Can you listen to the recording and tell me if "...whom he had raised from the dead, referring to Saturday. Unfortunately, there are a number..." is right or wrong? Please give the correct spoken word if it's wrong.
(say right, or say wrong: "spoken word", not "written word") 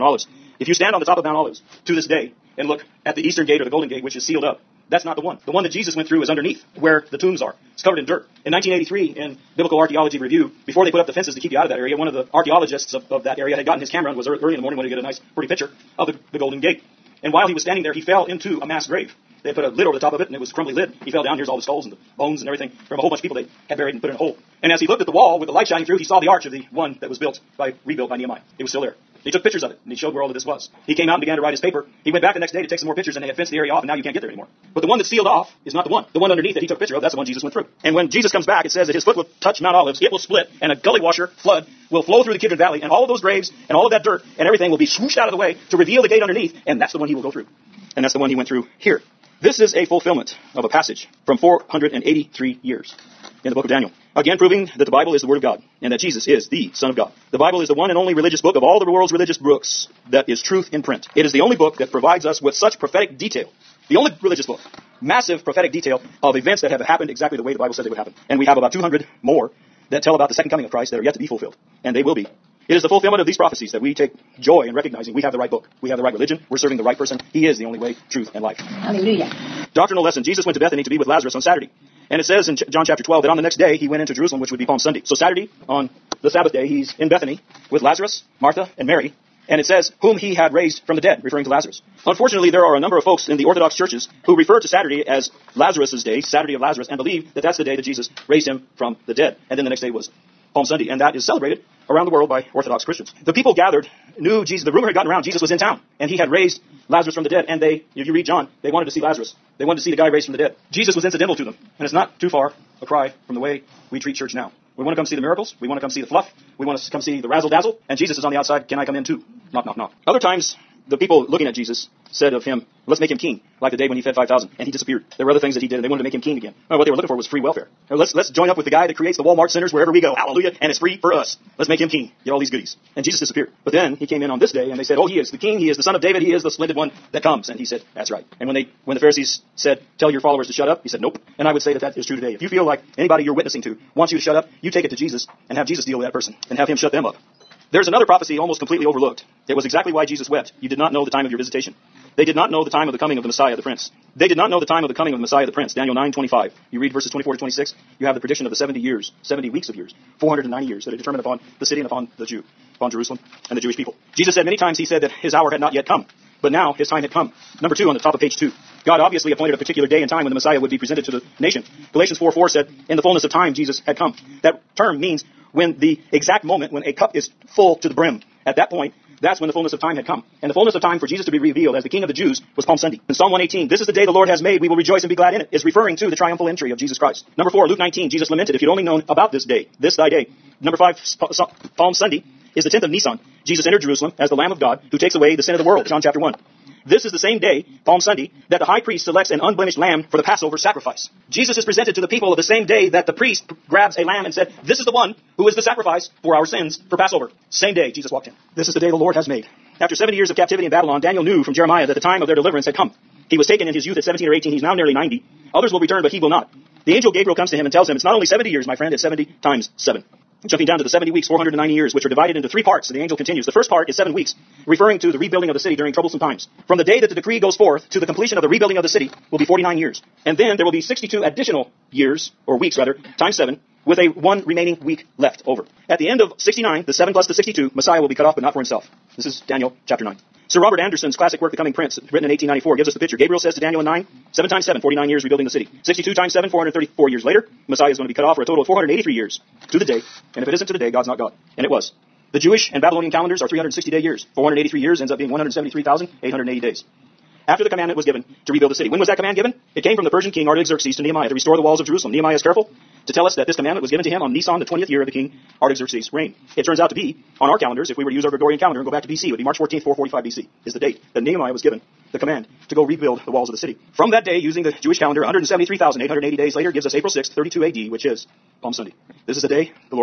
wrong: "Lazarus", not "Saturday".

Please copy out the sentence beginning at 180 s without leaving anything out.
And the fullness of time for Jesus to be revealed as the King of the Jews was Palm Sunday.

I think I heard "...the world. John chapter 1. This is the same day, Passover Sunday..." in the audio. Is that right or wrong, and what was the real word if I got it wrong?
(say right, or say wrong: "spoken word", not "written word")
wrong: "Palm", not "Passover".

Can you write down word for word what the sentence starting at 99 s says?
And then the next day was Palm Sunday, and that is celebrated around the world by Orthodox Christians.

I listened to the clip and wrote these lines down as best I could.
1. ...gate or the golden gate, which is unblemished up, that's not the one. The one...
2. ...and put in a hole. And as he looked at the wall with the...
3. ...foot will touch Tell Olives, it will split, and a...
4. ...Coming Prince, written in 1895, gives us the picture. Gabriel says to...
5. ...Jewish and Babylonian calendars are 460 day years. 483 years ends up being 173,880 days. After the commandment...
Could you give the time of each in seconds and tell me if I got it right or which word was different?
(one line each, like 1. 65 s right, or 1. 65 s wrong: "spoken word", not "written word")
1. 3 s wrong: "sealed", not "unblemished"
2. 23 s right
3. 39 s wrong: "Mount", not "Tell"
4. 241 s wrong: "1894", not "1895"
5. 252 s wrong: "360", not "460".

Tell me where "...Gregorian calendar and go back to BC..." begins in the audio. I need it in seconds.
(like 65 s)
268 s.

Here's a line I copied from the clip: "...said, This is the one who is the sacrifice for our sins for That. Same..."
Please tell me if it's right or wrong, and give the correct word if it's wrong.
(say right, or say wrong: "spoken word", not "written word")
wrong: "Passover", not "That".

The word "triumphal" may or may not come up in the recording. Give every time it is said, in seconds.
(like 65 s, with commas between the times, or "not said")
186 s.